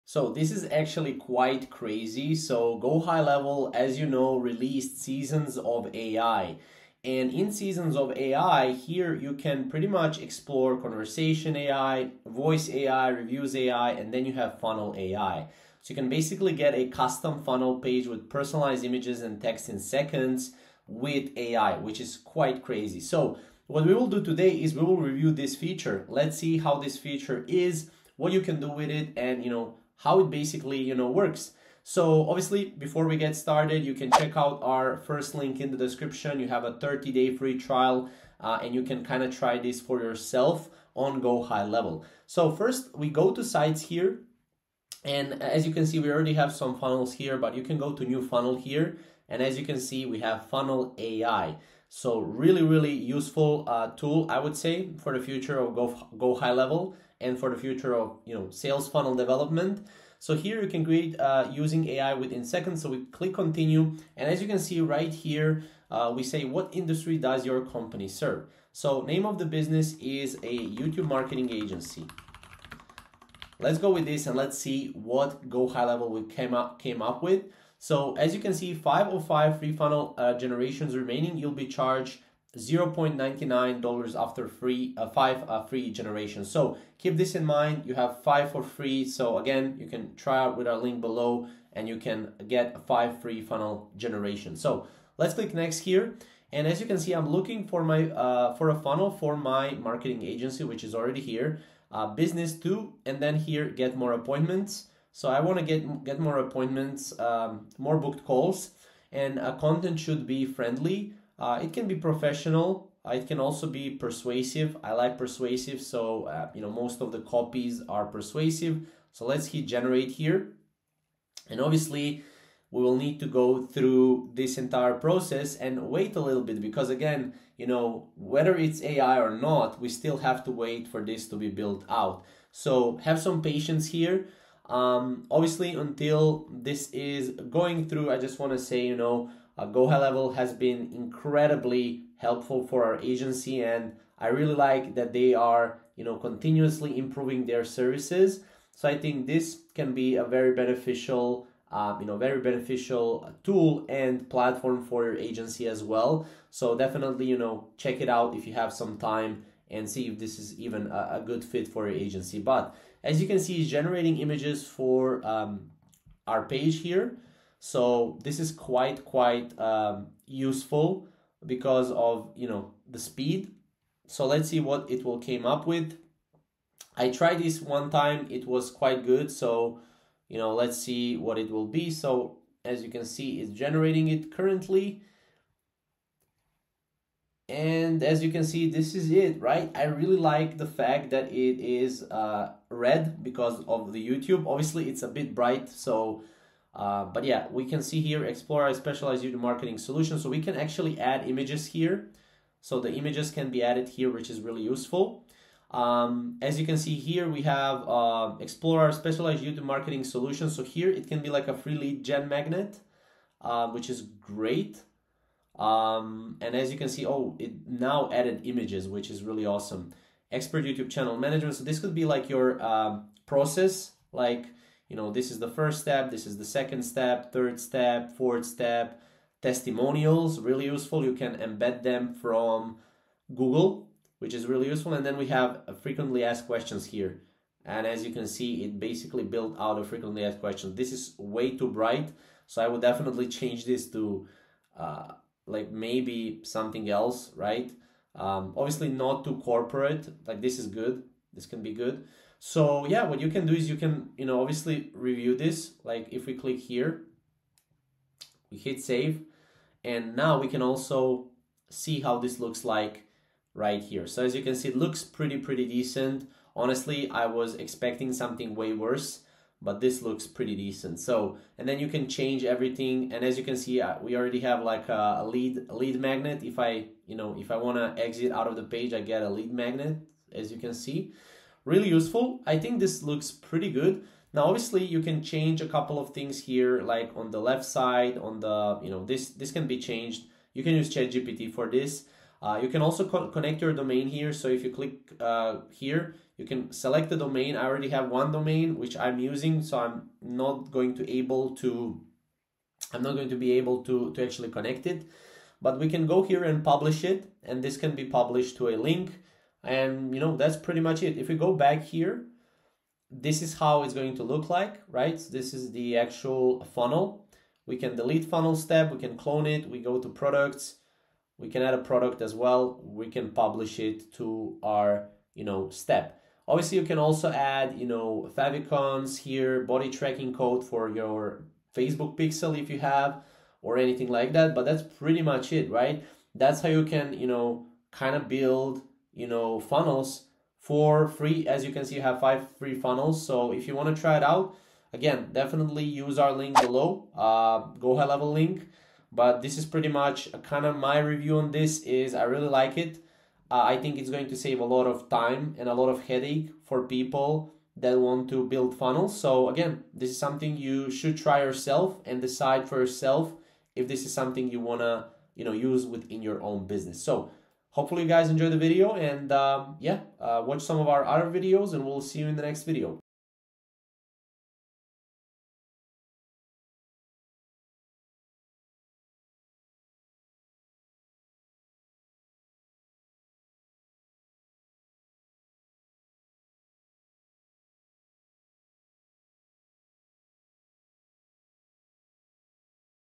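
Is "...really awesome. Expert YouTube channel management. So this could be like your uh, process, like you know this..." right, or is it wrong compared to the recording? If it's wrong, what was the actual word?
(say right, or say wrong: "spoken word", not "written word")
right.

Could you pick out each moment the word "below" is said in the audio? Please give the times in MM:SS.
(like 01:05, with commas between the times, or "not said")
01:30, 05:46.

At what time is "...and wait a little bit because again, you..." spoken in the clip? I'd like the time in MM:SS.
02:05.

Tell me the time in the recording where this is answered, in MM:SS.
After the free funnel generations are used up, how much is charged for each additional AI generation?
01:22.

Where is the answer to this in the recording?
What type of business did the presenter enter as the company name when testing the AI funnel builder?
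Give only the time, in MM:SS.
01:10.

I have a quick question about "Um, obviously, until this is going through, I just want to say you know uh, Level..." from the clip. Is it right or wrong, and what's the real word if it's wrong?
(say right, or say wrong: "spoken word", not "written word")
right.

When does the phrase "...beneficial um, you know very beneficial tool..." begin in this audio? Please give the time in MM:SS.
02:30.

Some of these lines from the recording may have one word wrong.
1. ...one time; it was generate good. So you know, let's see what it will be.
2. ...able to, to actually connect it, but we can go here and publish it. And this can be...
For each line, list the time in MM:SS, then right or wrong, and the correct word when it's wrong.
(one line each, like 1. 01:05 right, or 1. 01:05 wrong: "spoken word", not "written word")
1. 02:57 wrong: "quite", not "generate"
2. 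05:03 right.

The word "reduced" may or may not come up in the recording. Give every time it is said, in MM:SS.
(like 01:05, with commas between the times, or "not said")
not said.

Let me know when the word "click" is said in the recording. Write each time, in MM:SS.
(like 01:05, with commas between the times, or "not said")
01:03, 01:35, 04:16, 04:54.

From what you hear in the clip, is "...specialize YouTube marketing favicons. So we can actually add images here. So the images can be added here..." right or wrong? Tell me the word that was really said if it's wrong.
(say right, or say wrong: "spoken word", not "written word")
wrong: "solutions", not "favicons".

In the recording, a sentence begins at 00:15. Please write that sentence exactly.
So you can basically get a custom funnel page with personalized images and text in seconds with AI, which is quite crazy.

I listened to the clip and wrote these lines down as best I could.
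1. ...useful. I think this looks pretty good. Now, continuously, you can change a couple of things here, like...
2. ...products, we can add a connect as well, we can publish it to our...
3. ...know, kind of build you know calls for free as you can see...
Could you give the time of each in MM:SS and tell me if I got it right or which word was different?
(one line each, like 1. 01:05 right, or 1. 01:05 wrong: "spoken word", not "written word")
1. 04:41 wrong: "obviously", not "continuously"
2. 05:20 wrong: "product", not "connect"
3. 05:37 wrong: "funnels", not "calls".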